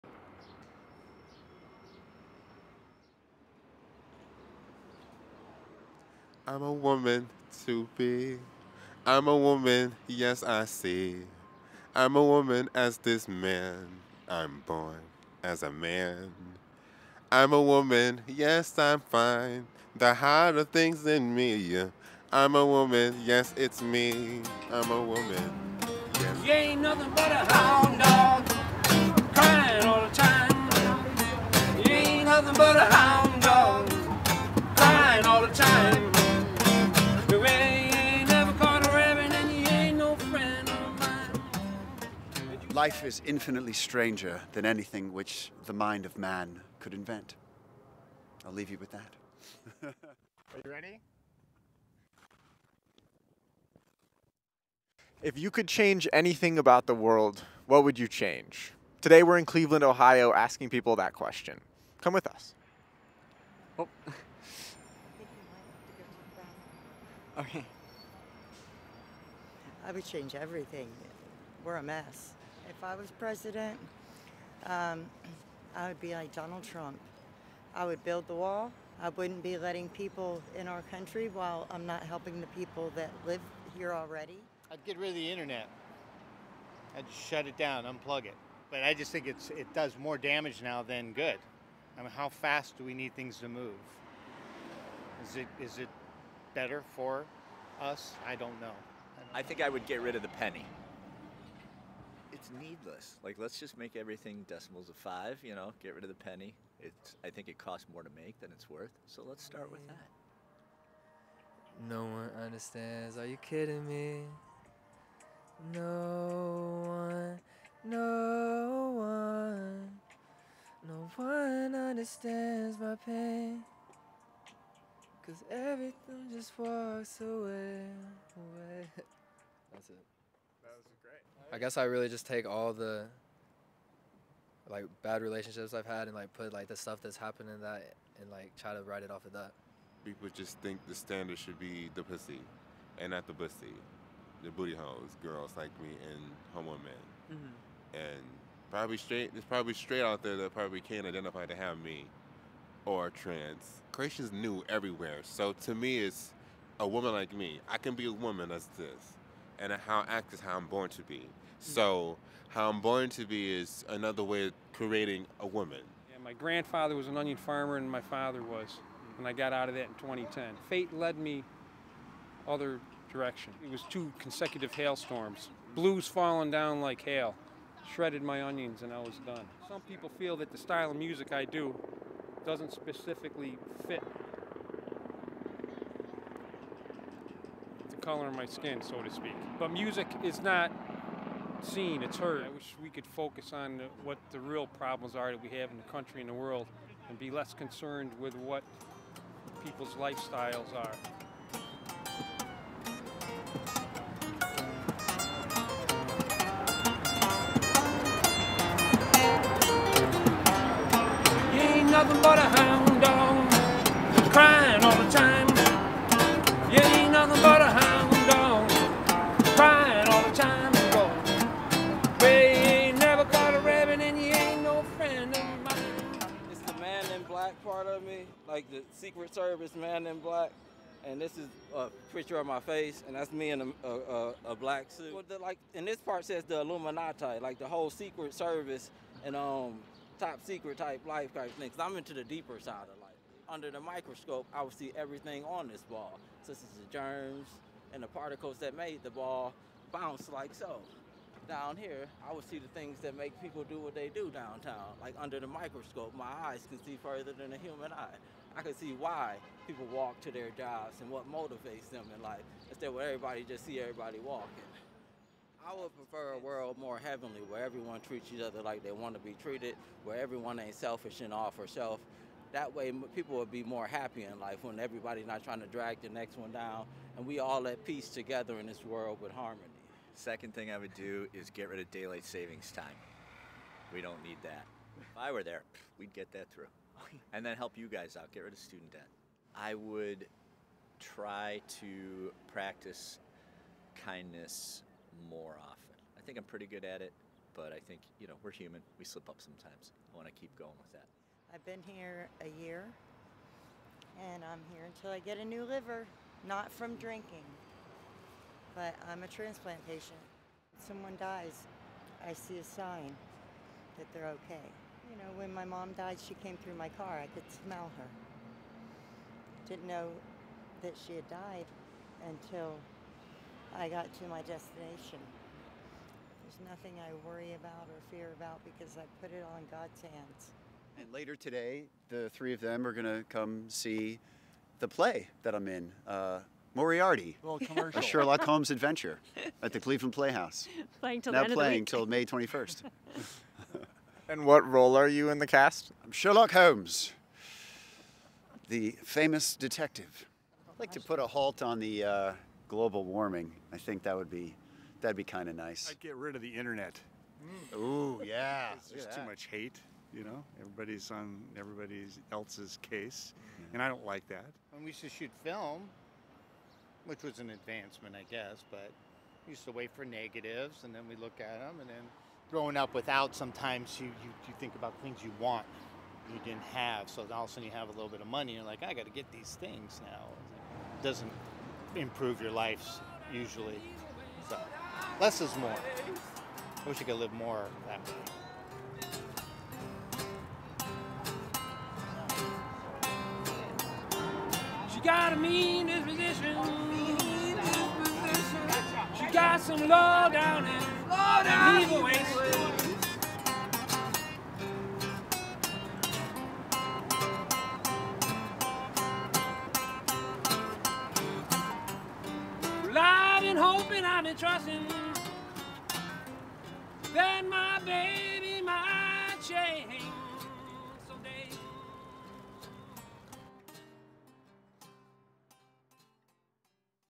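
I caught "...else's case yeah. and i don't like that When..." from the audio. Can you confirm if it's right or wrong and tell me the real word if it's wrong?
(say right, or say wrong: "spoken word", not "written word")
right.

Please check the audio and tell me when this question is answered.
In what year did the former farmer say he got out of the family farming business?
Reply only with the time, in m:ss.
2:49.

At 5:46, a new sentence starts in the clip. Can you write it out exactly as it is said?
I'm Sherlock Holmes, the famous detective.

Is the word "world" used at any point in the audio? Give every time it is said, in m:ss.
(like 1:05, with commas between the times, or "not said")
0:56, 3:16, 4:26, 4:38.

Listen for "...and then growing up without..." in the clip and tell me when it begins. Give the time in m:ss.
6:11.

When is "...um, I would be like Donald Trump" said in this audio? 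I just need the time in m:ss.
1:14.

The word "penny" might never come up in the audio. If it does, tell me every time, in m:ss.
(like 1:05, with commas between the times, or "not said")
1:40, 1:46.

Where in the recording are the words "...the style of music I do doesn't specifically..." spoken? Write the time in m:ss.
3:00.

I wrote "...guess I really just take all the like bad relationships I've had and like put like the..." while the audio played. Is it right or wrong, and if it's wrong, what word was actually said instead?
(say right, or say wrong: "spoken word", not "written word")
right.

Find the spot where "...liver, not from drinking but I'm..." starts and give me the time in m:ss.
5:05.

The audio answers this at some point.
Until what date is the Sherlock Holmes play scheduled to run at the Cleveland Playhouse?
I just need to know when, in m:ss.
5:42.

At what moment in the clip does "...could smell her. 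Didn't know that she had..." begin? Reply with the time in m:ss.
5:17.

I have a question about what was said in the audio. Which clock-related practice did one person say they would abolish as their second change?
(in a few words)
Daylight savings time.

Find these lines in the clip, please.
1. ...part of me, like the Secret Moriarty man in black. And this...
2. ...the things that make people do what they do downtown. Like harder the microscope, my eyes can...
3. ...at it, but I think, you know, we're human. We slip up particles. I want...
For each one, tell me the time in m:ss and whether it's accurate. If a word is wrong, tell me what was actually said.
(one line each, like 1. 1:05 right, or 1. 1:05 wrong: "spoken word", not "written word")
1. 3:47 wrong: "Service", not "Moriarty"
2. 4:12 wrong: "under", not "harder"
3. 4:56 wrong: "sometimes", not "particles".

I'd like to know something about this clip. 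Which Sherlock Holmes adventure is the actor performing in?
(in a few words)
Moriarty.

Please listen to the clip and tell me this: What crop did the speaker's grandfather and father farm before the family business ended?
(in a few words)
Onions.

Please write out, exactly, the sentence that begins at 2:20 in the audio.
People just think the standard should be the pussy and not the pussy.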